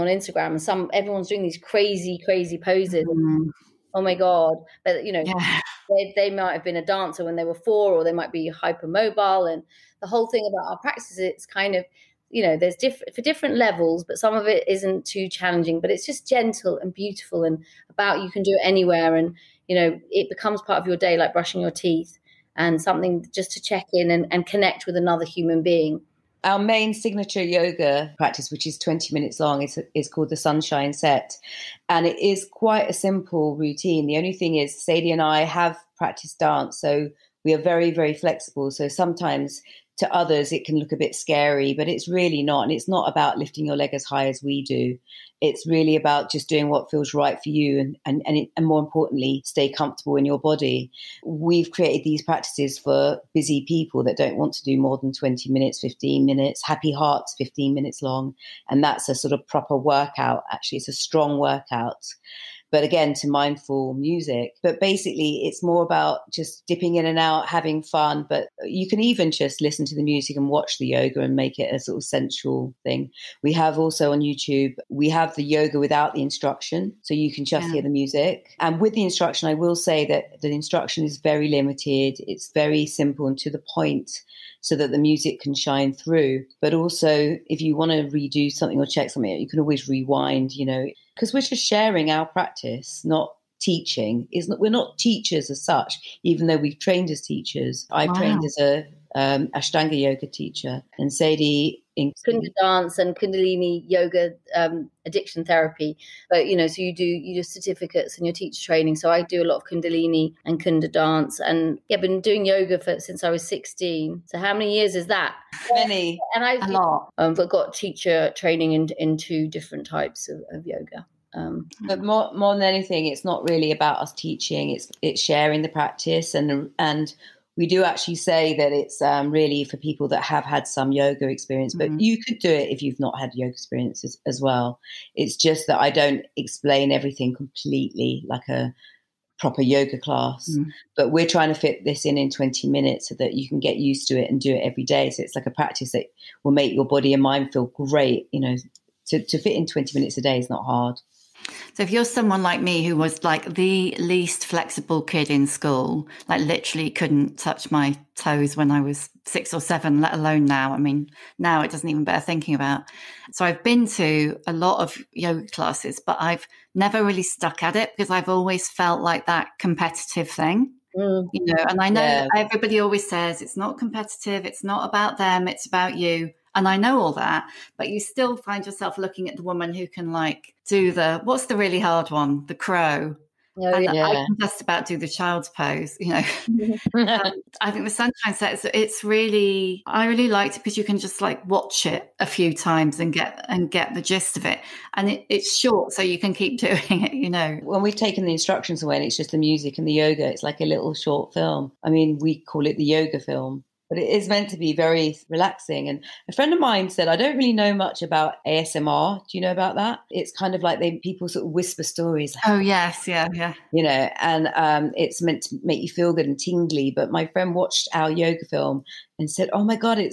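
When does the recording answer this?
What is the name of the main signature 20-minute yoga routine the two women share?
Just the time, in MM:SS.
00:30.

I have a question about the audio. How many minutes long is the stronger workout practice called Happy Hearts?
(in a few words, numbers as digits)
15.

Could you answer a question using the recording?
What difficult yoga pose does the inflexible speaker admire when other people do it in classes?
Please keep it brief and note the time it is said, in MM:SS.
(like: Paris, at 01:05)
The crow, at 03:02.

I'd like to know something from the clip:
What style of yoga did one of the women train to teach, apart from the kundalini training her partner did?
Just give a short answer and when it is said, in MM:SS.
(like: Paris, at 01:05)
Ashtanga, at 01:39.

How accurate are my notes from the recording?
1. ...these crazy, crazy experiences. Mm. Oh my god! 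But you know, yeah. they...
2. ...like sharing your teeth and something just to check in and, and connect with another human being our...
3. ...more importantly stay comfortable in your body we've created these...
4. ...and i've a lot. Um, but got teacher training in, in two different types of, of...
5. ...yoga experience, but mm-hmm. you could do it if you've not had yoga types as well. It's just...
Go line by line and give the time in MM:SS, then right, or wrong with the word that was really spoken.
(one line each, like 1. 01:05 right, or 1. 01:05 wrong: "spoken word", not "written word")
1. 00:01 wrong: "poses", not "experiences"
2. 00:21 wrong: "brushing", not "sharing"
3. 00:48 right
4. 01:56 right
5. 02:10 wrong: "experiences", not "types".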